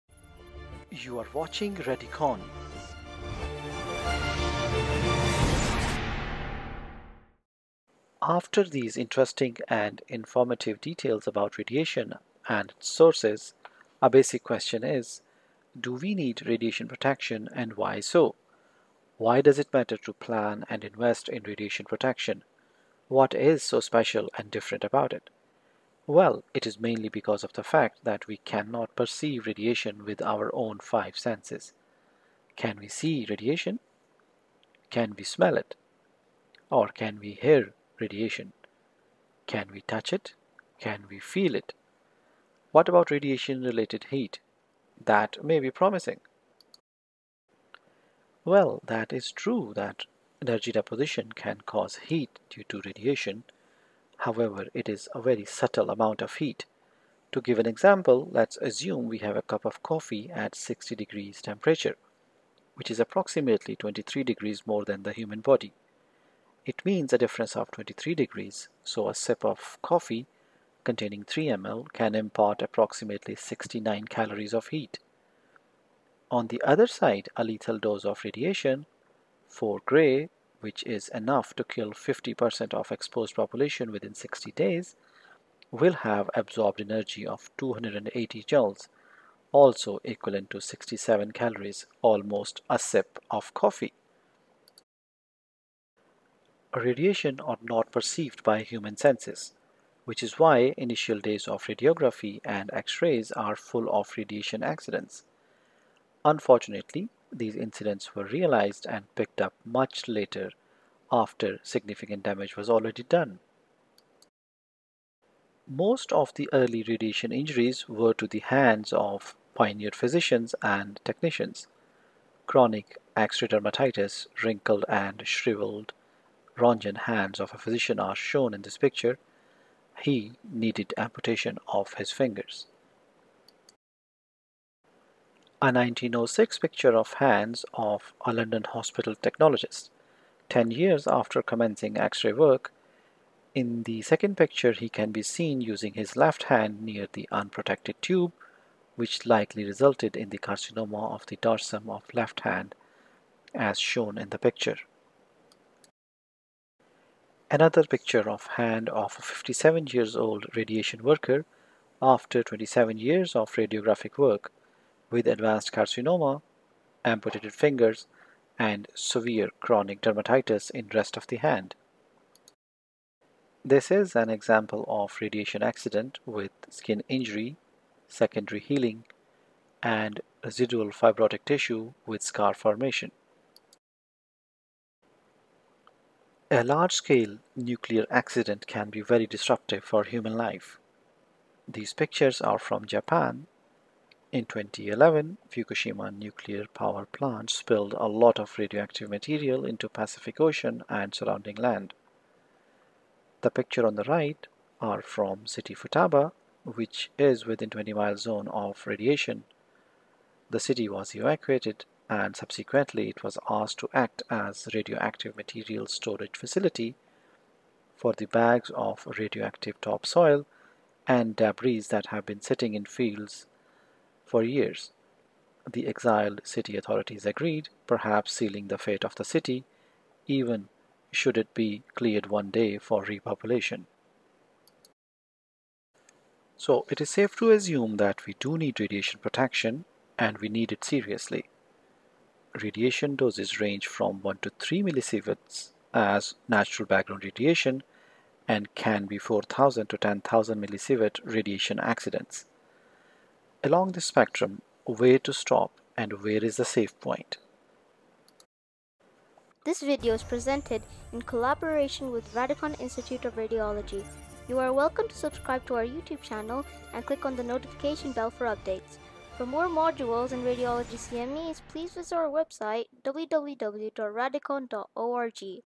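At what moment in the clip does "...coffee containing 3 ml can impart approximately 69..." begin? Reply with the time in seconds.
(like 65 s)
69 s.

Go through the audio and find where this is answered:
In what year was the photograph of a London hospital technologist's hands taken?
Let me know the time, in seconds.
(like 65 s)
135 s.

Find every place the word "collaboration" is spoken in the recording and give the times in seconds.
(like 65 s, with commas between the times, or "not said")
261 s.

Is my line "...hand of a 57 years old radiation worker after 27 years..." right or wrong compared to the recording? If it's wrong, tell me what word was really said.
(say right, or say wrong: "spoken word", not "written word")
right.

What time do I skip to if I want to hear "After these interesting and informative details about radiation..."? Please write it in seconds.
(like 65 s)
8 s.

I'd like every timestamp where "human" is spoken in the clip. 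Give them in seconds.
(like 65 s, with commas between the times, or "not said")
65 s, 98 s, 190 s.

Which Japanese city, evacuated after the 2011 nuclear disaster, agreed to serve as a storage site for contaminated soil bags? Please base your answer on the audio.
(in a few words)
Futaba.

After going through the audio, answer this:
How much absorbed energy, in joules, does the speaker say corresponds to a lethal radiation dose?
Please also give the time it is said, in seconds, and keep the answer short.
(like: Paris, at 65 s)
280 joules, at 87 s.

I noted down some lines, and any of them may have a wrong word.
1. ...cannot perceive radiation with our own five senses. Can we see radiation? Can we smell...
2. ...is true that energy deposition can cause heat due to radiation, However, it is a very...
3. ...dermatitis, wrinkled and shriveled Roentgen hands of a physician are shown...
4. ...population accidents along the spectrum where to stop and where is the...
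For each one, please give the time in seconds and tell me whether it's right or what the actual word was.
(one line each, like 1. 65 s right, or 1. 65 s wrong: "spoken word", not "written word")
1. 28 s right
2. 49 s right
3. 123 s right
4. 251 s wrong: "radiation", not "population".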